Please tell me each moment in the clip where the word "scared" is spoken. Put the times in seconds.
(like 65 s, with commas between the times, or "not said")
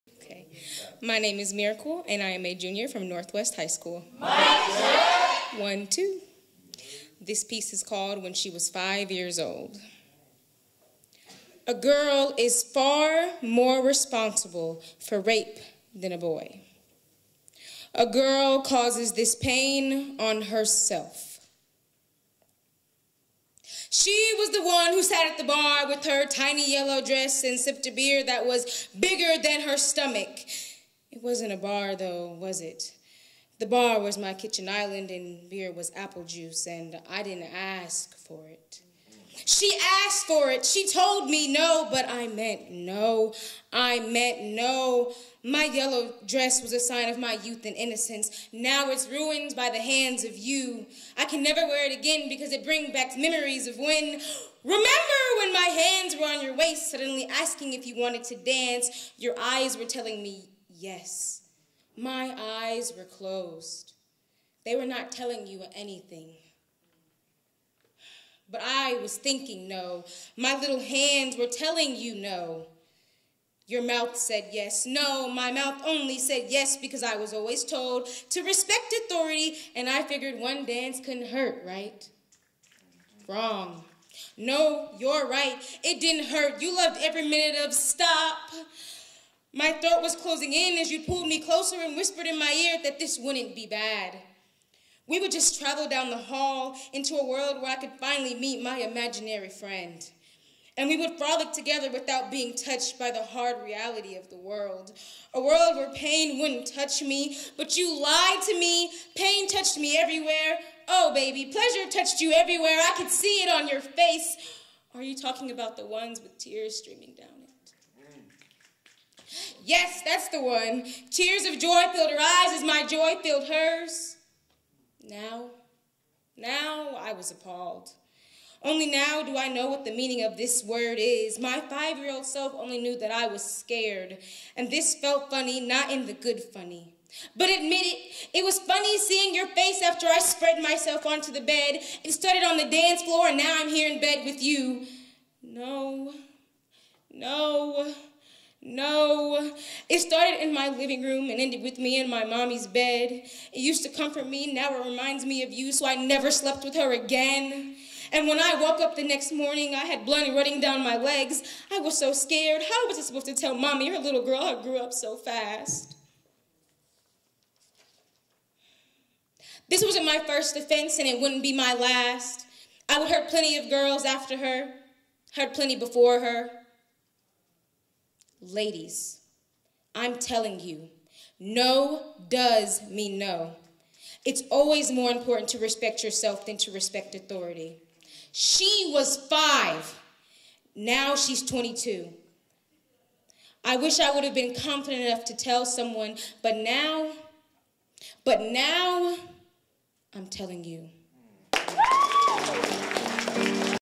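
133 s, 162 s.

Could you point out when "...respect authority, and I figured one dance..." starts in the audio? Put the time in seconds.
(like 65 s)
78 s.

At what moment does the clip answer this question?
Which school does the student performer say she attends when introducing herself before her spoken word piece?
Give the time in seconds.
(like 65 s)
3 s.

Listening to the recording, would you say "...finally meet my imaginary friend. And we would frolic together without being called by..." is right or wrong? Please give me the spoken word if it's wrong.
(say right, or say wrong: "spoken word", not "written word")
wrong: "touched", not "called".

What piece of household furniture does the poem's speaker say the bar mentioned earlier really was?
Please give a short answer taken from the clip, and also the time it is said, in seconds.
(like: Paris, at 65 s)
kitchen island, at 34 s.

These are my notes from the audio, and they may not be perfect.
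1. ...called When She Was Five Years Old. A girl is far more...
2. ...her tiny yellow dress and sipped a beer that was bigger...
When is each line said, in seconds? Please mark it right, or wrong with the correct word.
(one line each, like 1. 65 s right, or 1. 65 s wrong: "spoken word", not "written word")
1. 7 s right
2. 26 s right.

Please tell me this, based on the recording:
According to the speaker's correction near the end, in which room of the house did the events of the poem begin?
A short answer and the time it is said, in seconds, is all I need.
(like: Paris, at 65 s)
living room, at 150 s.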